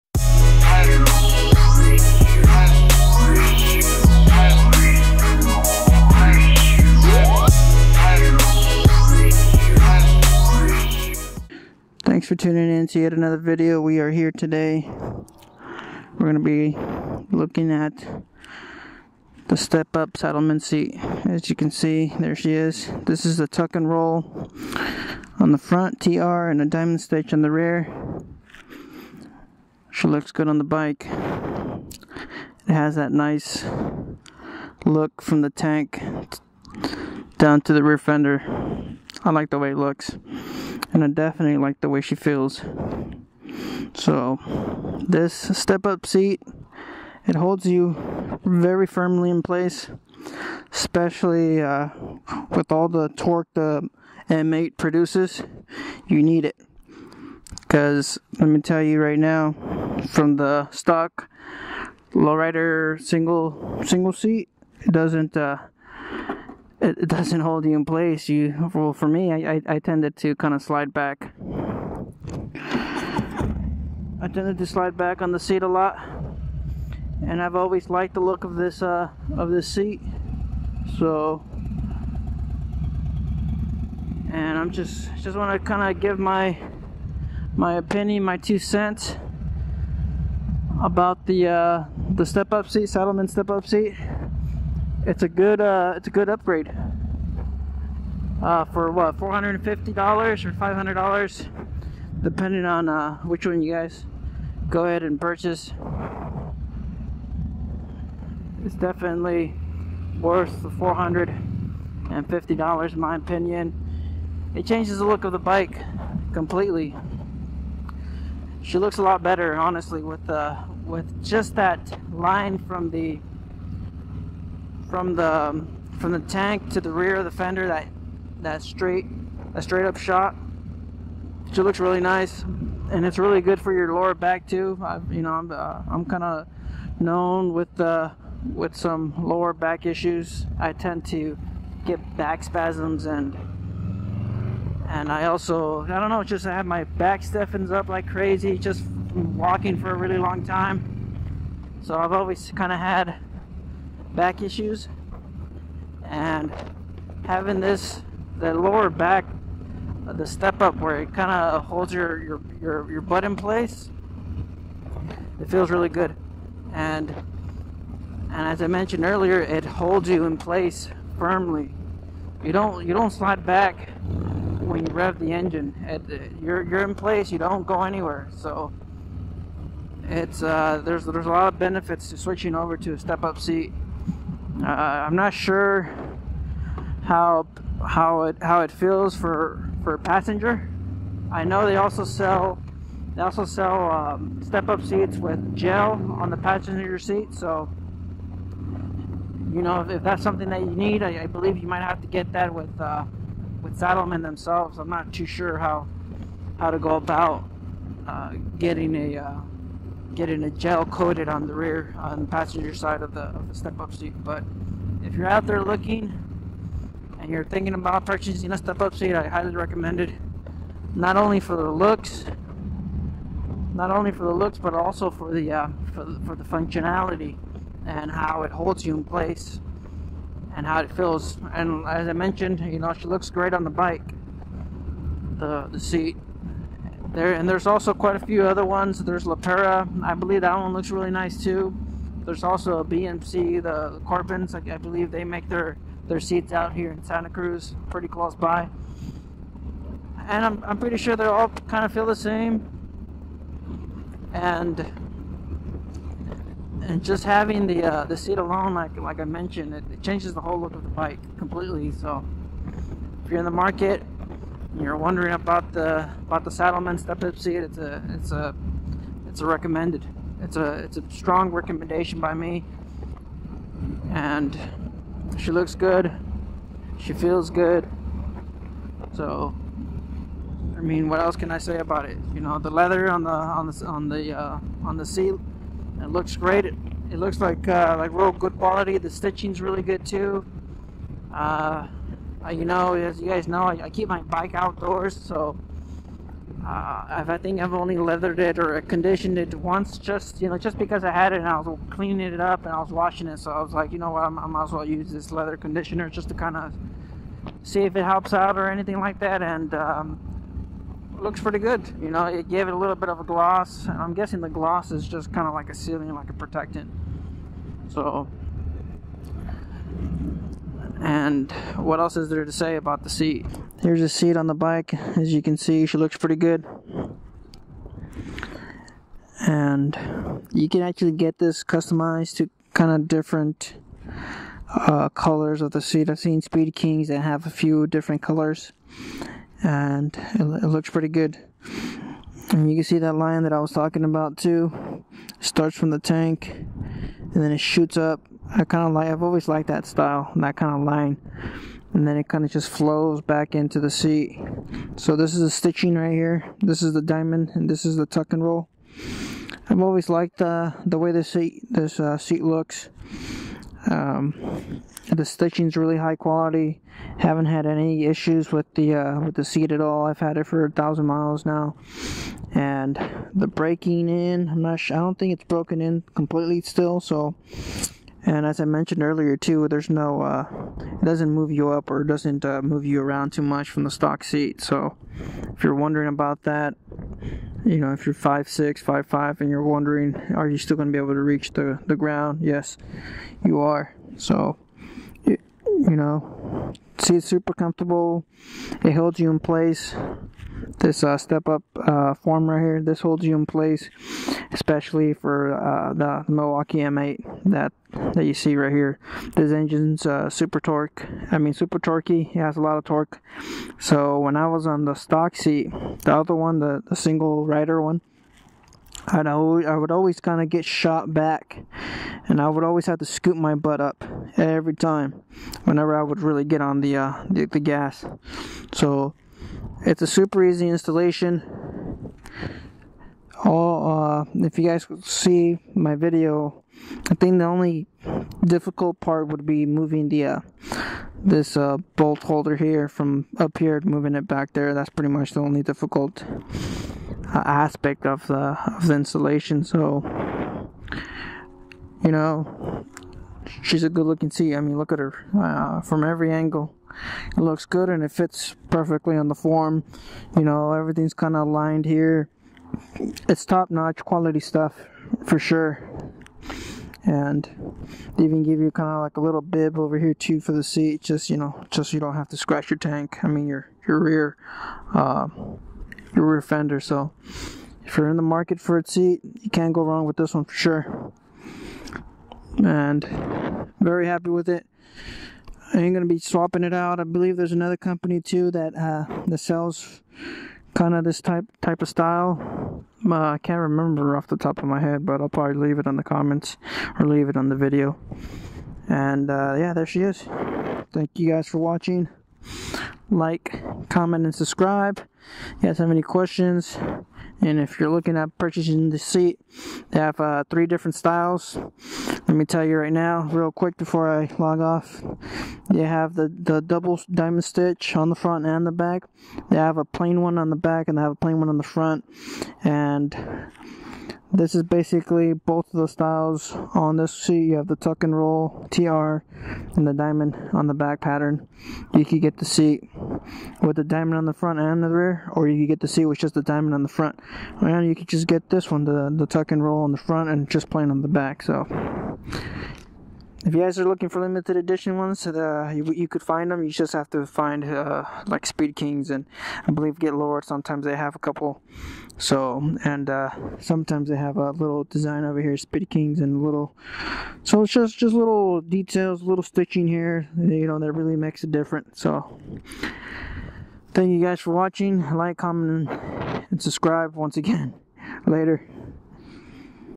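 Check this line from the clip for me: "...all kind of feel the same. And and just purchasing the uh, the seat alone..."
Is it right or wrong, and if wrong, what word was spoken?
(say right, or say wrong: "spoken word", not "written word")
wrong: "having", not "purchasing".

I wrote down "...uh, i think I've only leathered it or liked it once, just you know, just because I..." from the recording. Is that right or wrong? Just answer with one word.
wrong.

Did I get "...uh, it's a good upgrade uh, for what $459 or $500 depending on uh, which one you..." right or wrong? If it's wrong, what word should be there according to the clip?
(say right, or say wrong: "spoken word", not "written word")
wrong: "450", not "459".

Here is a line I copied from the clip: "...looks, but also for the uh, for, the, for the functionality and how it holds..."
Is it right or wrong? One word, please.
right.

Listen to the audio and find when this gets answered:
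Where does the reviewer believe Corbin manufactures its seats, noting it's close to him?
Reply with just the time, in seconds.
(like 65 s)
247 s.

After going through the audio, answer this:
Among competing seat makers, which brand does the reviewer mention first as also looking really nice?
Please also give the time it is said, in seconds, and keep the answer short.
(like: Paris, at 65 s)
Le Pera, at 239 s.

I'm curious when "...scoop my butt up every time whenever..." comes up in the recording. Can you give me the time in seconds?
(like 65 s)
423 s.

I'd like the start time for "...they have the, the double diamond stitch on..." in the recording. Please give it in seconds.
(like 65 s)
515 s.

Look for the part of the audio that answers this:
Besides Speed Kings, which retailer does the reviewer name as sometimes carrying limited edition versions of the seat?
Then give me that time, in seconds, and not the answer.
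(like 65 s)
549 s.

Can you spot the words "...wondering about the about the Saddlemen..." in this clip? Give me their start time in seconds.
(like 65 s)
264 s.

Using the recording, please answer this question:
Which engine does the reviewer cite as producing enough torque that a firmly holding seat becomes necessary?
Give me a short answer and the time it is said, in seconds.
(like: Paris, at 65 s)
M8, at 53 s.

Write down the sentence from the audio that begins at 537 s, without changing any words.
And you could just get this one, the, the tuck and roll on the front and just plain on the back.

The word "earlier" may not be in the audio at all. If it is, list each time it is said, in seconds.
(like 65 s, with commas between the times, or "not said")
169 s, 379 s.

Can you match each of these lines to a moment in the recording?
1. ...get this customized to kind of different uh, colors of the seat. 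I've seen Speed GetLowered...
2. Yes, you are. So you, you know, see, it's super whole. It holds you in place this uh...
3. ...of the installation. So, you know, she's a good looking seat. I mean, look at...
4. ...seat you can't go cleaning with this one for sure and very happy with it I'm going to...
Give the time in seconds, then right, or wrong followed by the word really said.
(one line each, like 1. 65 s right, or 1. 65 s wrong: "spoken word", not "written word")
1. 331 s wrong: "Kings", not "GetLowered"
2. 392 s wrong: "comfortable", not "whole"
3. 448 s right
4. 478 s wrong: "wrong", not "cleaning".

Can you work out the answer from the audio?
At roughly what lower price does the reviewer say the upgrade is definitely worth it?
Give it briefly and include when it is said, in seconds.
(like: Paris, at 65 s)
$450, at 108 s.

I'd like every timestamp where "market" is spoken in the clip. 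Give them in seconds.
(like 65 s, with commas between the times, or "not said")
263 s, 478 s.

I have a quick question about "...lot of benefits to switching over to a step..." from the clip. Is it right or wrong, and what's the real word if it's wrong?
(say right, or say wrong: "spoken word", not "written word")
right.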